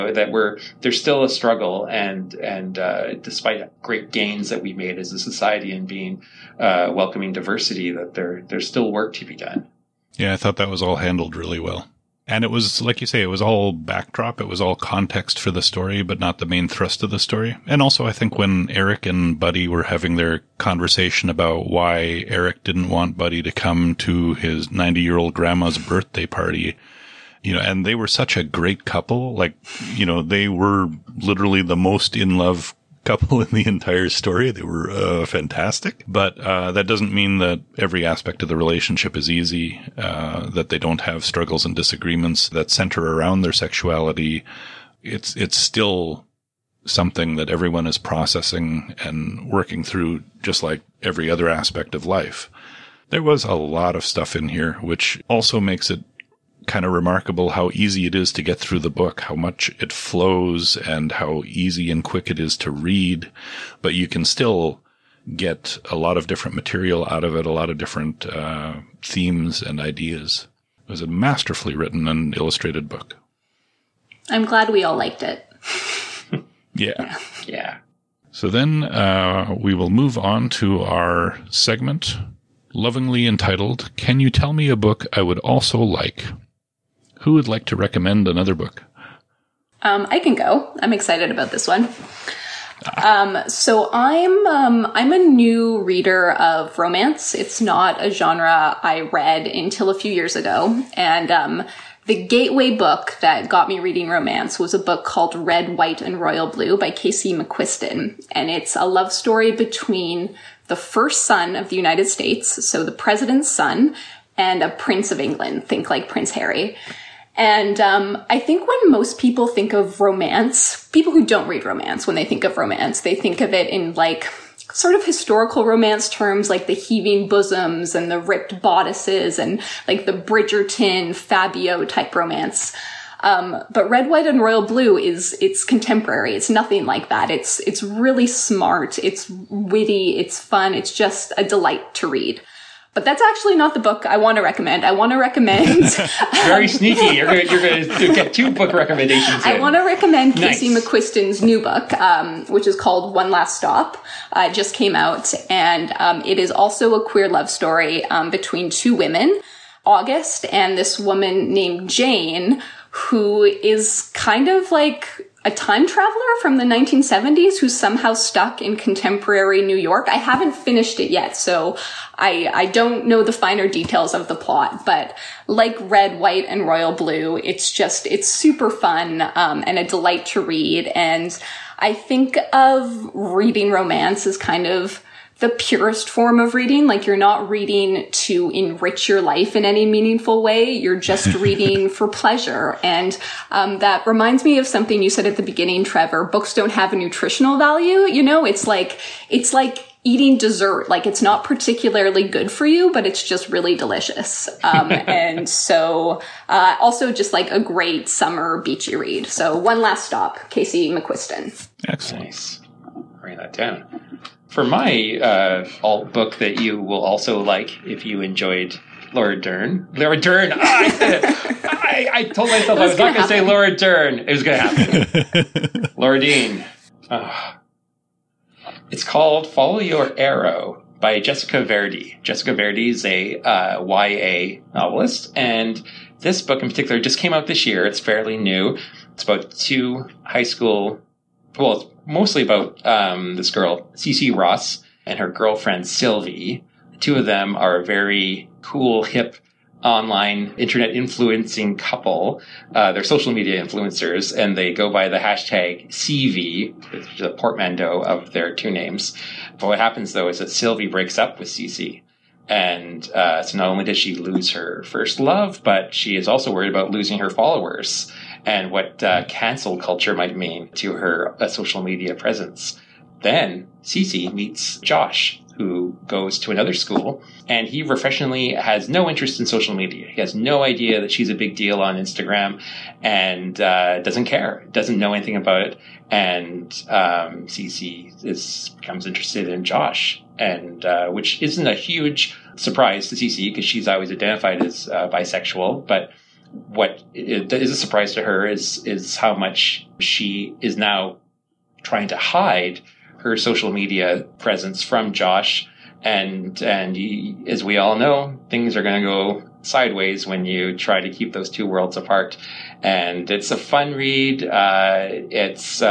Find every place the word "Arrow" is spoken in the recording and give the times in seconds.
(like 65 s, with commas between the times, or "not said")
230 s.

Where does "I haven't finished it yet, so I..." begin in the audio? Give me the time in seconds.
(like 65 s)
170 s.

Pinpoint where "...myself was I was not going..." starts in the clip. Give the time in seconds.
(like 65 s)
222 s.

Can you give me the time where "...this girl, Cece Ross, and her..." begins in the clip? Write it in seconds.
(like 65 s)
243 s.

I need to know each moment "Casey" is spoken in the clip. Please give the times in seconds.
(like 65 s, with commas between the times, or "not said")
106 s, 150 s, 210 s.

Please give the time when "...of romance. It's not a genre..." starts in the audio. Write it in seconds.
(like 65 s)
96 s.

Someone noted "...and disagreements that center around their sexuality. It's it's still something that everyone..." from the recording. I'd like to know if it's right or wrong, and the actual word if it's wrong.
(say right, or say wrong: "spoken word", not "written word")
right.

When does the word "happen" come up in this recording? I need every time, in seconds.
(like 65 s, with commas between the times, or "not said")
224 s, 259 s.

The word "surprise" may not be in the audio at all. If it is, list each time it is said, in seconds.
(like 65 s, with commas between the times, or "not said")
292 s, 297 s.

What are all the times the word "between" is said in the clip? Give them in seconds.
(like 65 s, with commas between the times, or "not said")
109 s, 158 s.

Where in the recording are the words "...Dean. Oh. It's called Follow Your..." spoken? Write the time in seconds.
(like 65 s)
226 s.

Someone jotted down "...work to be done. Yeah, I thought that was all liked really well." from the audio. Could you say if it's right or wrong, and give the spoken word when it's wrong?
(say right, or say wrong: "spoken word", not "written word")
wrong: "handled", not "liked".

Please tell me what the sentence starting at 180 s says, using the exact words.
And I think of reading romance as kind of the purest form of reading.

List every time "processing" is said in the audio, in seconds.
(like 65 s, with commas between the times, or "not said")
47 s.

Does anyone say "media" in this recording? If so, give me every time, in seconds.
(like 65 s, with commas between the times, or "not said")
253 s, 271 s, 279 s, 303 s.